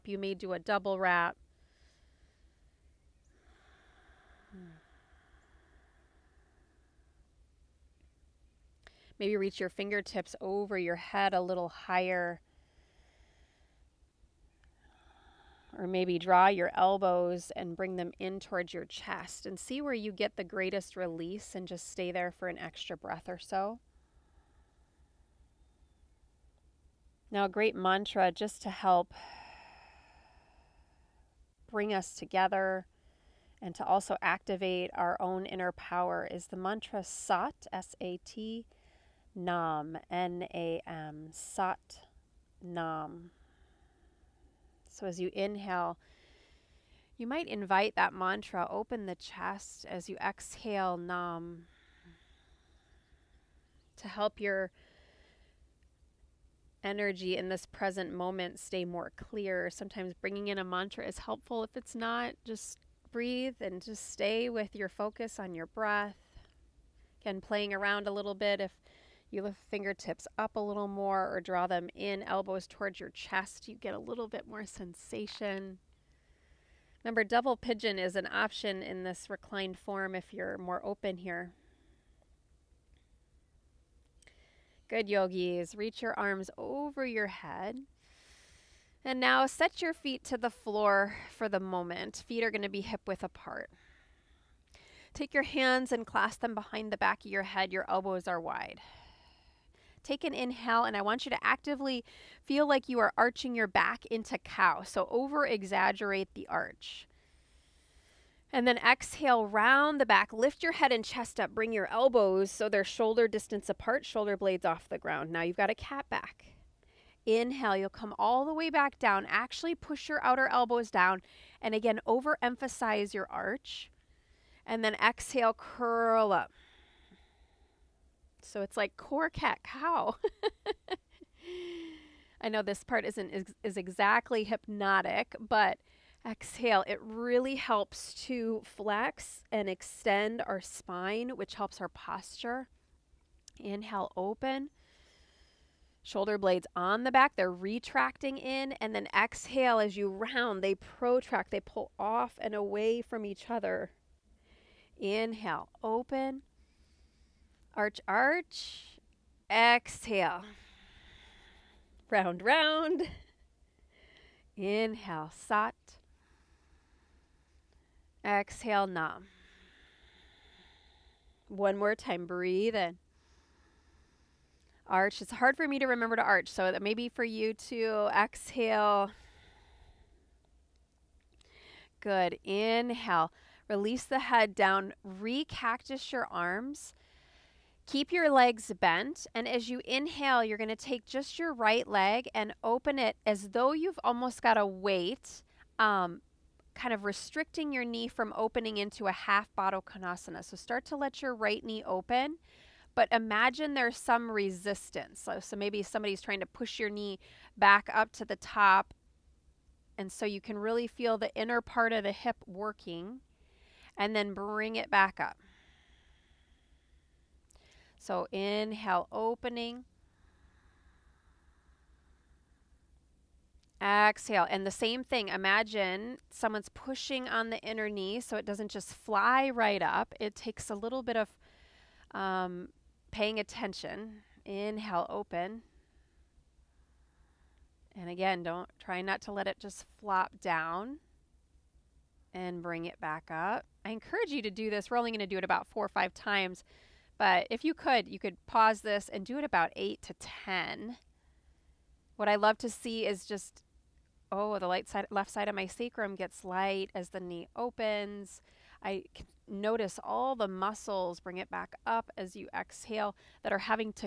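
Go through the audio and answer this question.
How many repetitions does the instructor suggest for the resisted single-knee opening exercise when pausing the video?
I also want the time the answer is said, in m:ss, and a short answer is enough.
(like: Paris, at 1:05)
8 to 10, at 4:09.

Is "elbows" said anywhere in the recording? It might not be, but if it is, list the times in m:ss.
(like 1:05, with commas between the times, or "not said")
0:16, 1:12, 1:37, 1:51, 2:00.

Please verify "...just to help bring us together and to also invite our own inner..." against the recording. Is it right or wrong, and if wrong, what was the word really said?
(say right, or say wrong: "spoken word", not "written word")
wrong: "activate", not "invite".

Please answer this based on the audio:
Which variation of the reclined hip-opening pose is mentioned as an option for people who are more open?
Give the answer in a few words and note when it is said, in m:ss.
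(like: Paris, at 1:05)
double pigeon, at 1:17.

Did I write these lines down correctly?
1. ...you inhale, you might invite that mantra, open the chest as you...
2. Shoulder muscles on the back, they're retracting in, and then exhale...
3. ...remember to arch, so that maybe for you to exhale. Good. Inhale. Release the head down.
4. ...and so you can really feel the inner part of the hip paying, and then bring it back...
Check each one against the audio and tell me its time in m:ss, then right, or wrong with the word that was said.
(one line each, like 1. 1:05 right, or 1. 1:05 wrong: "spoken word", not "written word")
1. 0:45 right
2. 2:26 wrong: "blades", not "muscles"
3. 2:55 right
4. 3:29 wrong: "working", not "paying".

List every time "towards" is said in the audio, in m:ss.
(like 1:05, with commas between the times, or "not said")
0:18, 1:12.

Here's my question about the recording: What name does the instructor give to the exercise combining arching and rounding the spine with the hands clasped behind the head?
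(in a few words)
core cat cow.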